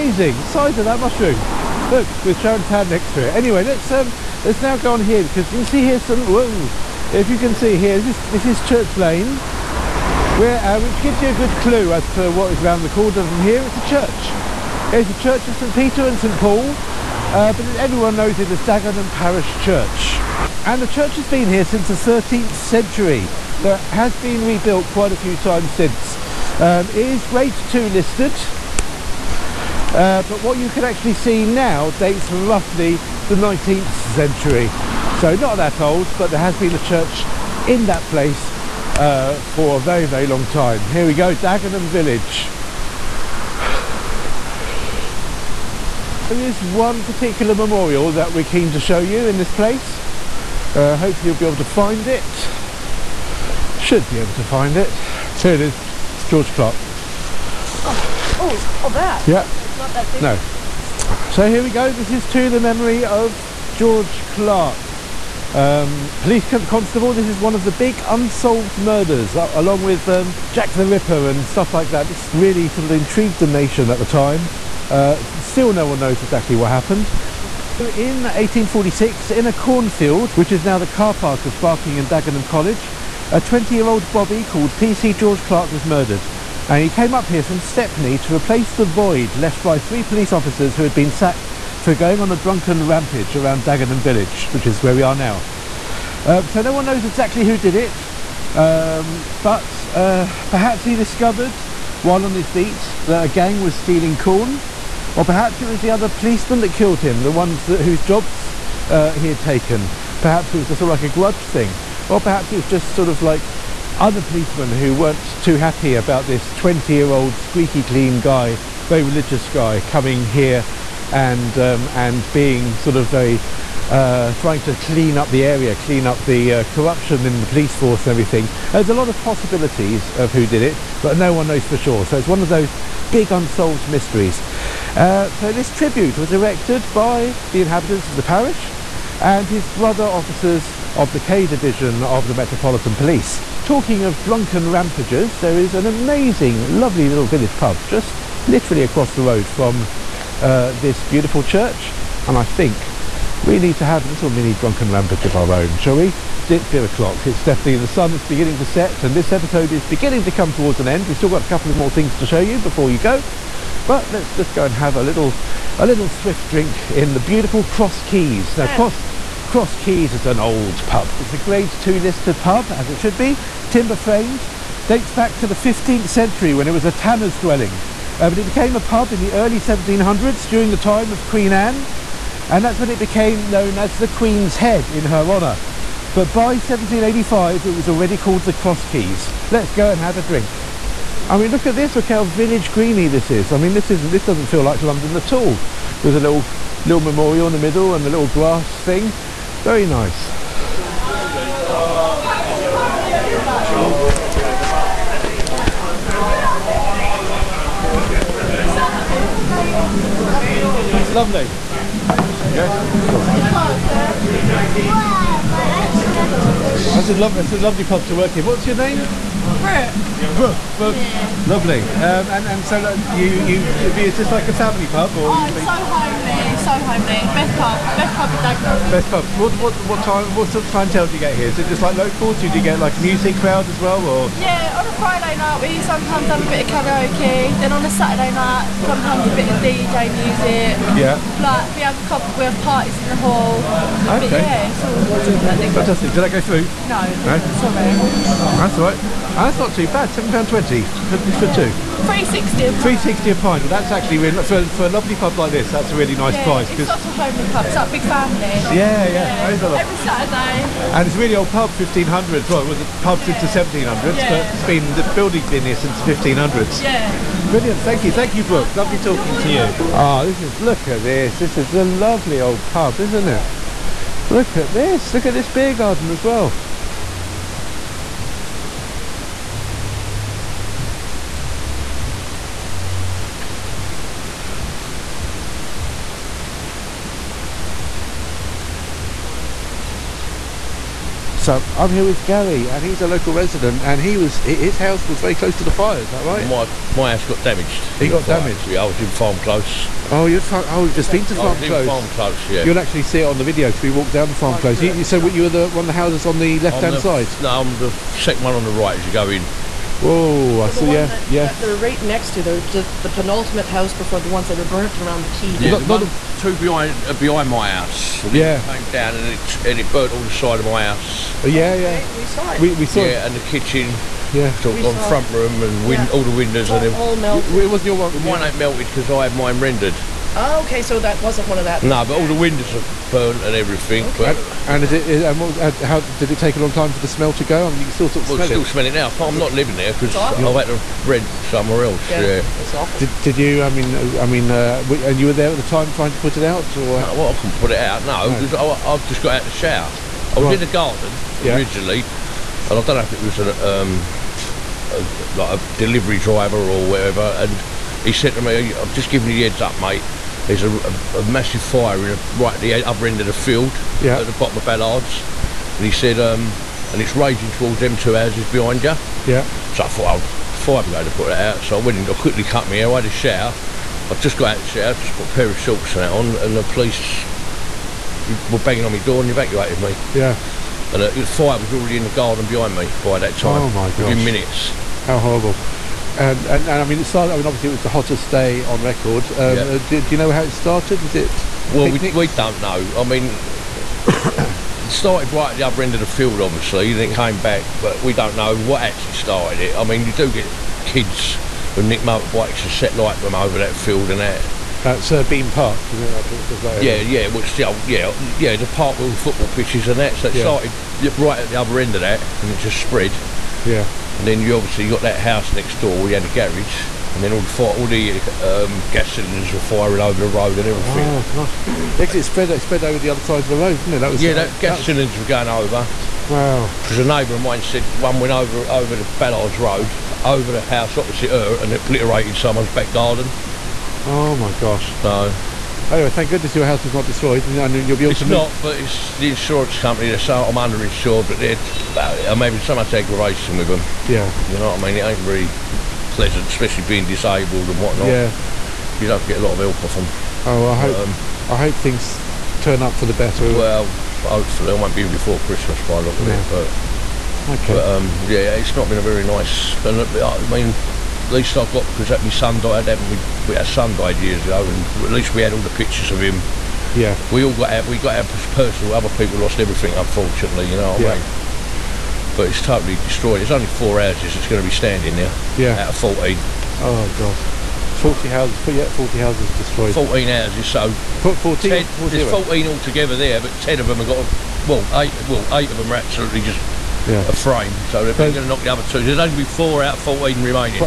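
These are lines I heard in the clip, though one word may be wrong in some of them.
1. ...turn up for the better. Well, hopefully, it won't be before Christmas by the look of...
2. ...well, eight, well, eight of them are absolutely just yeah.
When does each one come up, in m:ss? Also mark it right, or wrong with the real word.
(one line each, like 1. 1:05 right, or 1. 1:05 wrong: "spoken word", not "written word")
1. 7:32 right
2. 8:04 right.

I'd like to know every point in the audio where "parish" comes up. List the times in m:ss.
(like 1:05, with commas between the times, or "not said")
0:19, 2:18.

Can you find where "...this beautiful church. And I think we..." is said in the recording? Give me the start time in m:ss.
2:30.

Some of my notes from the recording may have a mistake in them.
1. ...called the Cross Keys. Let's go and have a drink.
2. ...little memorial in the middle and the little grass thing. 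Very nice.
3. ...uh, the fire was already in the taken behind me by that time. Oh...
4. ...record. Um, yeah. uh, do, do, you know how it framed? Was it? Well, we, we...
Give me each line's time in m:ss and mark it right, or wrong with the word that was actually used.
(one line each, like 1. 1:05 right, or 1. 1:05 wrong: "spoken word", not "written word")
1. 3:08 right
2. 3:16 right
3. 6:21 wrong: "garden", not "taken"
4. 6:28 wrong: "started", not "framed".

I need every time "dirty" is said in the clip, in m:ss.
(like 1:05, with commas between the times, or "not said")
not said.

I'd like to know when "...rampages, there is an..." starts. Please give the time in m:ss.
2:24.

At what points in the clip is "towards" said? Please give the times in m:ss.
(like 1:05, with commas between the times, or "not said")
2:40, 6:07.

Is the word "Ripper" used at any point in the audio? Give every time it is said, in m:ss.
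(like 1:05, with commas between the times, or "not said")
1:10.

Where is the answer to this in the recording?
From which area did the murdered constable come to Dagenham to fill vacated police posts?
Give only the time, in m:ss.
1:27.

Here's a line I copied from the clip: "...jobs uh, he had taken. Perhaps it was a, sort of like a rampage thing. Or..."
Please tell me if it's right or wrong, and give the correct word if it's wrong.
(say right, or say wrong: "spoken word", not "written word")
wrong: "grudge", not "rampage".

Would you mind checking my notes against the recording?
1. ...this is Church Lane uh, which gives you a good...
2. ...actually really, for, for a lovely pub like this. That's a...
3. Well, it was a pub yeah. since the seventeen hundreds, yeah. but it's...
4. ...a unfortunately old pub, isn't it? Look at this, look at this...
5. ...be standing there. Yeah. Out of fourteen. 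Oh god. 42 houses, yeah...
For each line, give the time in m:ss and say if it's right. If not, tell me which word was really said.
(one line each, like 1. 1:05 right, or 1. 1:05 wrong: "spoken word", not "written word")
1. 0:08 right
2. 4:13 right
3. 4:22 right
4. 4:31 wrong: "lovely", not "unfortunately"
5. 7:54 wrong: "40", not "42".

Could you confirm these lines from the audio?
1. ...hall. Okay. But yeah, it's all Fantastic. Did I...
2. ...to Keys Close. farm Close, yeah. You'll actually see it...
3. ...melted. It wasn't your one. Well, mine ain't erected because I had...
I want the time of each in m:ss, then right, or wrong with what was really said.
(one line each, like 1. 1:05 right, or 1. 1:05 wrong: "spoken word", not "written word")
1. 4:03 right
2. 5:01 wrong: "Farm", not "Keys"
3. 5:27 wrong: "melted", not "erected".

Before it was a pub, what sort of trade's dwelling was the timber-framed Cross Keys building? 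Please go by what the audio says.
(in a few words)
A tanner's.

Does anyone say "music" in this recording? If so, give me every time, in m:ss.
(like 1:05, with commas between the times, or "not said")
3:52, 4:00.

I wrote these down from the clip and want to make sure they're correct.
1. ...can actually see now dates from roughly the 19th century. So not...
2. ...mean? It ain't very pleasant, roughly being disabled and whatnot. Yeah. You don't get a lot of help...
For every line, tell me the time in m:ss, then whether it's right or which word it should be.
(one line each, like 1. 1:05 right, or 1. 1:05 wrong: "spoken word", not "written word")
1. 0:30 right
2. 7:24 wrong: "especially", not "roughly".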